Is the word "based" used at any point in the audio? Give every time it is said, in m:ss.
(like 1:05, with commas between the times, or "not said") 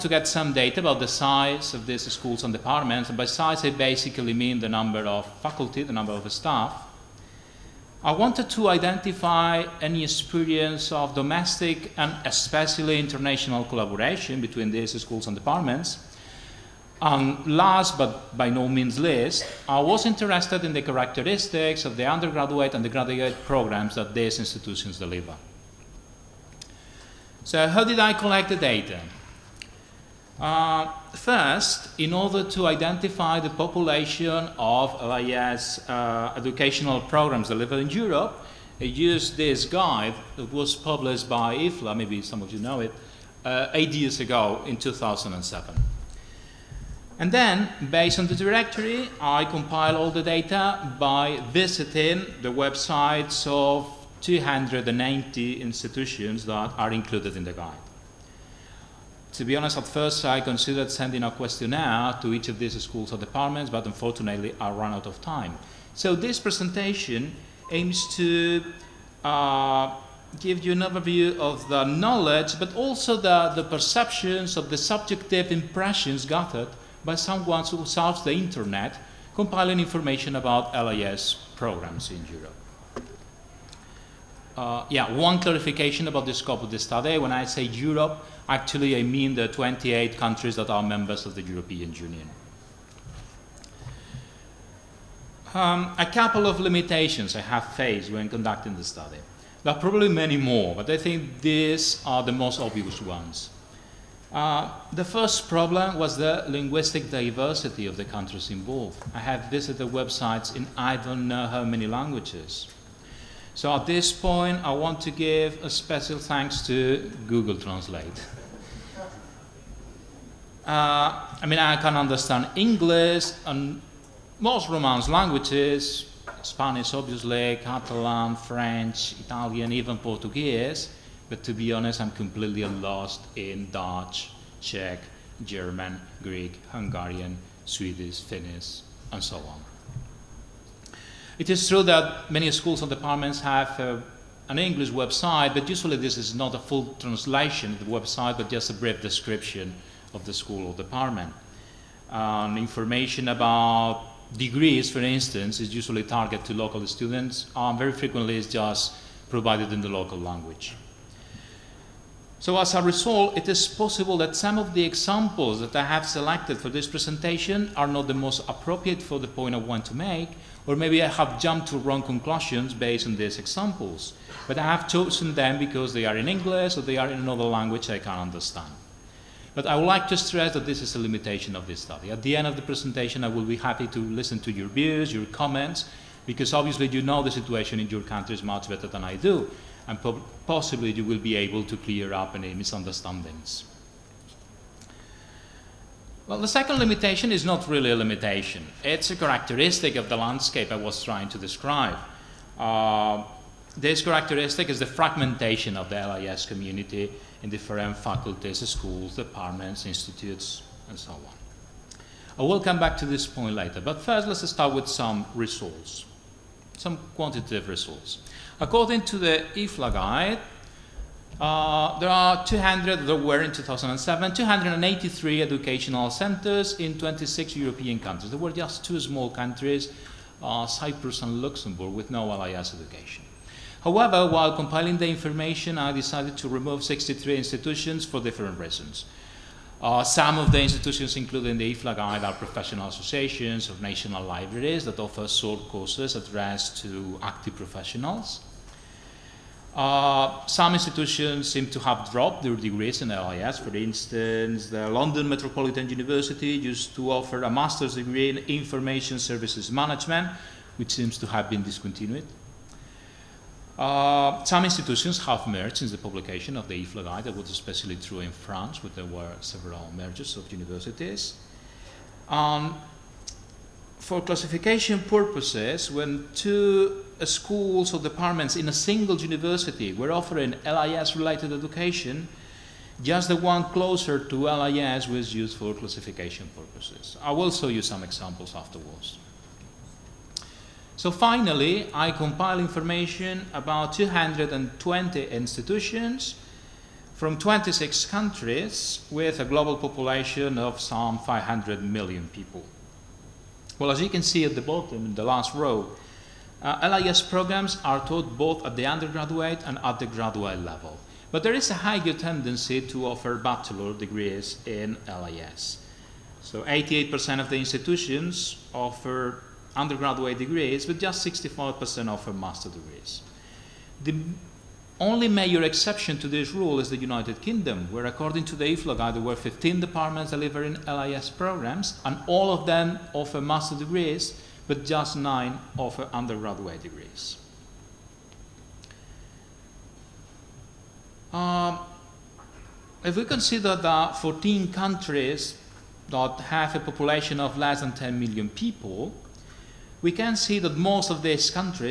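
0:47, 2:52.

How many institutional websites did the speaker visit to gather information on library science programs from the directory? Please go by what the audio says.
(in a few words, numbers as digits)
290.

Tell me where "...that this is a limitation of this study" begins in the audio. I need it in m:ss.
3:00.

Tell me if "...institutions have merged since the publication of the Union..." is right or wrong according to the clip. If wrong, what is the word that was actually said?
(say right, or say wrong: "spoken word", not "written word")
wrong: "IFLA", not "Union".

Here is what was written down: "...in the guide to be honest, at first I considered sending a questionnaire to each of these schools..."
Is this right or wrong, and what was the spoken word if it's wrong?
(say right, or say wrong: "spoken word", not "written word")
right.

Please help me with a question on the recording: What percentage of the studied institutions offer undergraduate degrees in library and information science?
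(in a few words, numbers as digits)
88%.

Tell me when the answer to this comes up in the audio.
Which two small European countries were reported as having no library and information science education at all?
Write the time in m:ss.
3:50.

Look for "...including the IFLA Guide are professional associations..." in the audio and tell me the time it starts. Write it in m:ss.
4:01.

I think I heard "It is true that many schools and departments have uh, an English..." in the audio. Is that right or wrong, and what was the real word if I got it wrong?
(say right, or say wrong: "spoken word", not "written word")
right.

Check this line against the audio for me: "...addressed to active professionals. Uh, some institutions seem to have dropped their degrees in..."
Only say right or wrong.
right.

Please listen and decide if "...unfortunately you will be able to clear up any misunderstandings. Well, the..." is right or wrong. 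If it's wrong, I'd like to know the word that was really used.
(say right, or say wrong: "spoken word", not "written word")
wrong: "possibly", not "unfortunately".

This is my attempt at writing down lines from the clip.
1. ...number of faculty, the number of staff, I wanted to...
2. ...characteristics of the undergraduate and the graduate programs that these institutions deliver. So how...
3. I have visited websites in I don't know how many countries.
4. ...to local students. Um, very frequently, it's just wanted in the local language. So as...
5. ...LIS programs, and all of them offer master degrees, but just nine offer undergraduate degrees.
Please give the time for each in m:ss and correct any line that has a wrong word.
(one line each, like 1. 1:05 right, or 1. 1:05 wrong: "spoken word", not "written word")
1. 0:04 right
2. 0:20 right
3. 1:49 wrong: "languages", not "countries"
4. 2:36 wrong: "provided", not "wanted"
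5. 5:30 right.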